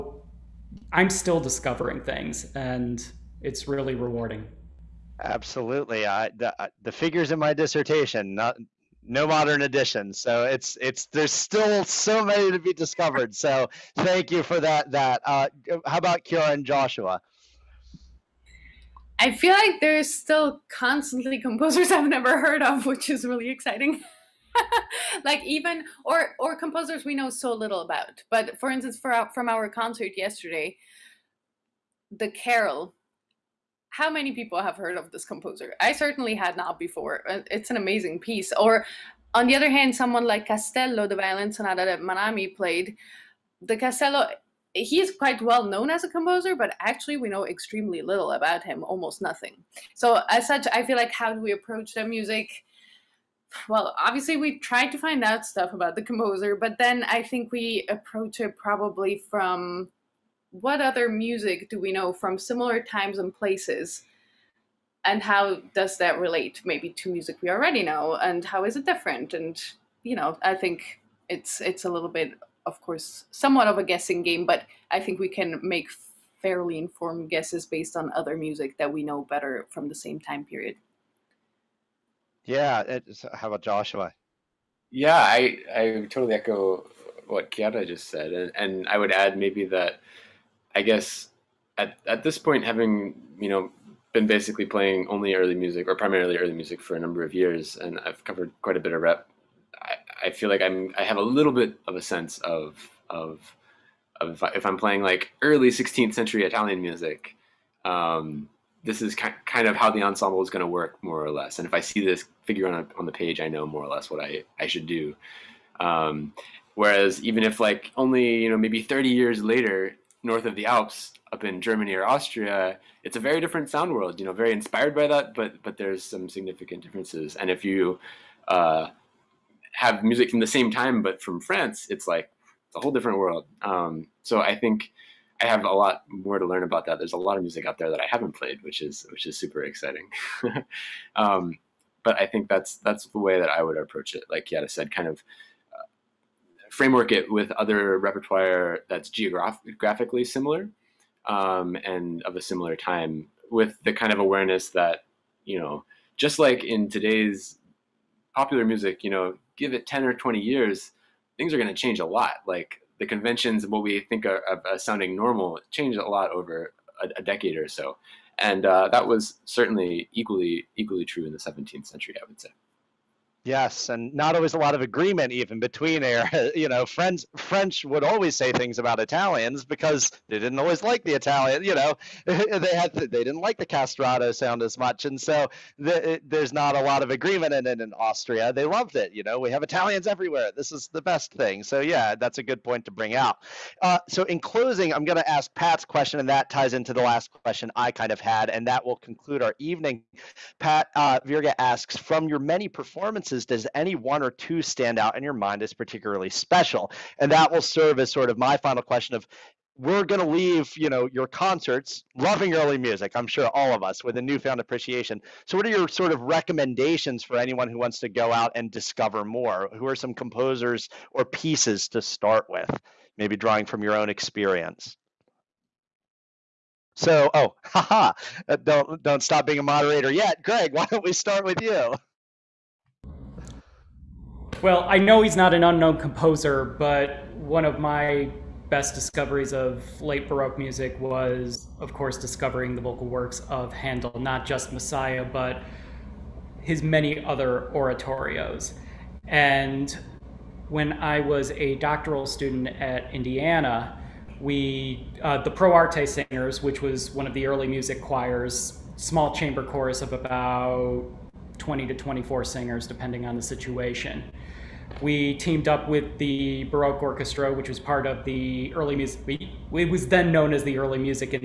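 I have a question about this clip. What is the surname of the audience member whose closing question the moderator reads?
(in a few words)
Virga.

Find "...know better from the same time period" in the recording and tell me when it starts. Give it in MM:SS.
01:19.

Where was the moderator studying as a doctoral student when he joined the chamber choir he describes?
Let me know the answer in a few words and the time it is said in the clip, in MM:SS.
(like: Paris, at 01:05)
Indiana, at 04:13.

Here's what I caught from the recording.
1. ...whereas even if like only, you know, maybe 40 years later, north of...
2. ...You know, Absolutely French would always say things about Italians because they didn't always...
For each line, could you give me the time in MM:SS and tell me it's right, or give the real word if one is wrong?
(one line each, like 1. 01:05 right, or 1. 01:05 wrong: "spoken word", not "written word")
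1. 01:56 wrong: "30", not "40"
2. 02:56 wrong: "French", not "Absolutely".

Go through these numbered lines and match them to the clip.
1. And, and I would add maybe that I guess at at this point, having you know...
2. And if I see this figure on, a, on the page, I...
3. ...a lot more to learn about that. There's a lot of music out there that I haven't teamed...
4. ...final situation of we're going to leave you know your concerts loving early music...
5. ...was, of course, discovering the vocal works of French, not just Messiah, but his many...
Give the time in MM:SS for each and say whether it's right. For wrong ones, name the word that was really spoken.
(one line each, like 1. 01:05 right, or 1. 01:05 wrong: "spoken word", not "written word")
1. 01:28 right
2. 01:51 right
3. 02:15 wrong: "played", not "teamed"
4. 03:28 wrong: "question", not "situation"
5. 04:00 wrong: "Handel", not "French".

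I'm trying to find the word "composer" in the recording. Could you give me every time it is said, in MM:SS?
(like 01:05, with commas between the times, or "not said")
00:21, 00:26, 00:35, 00:46, 00:56, 03:40, 03:55.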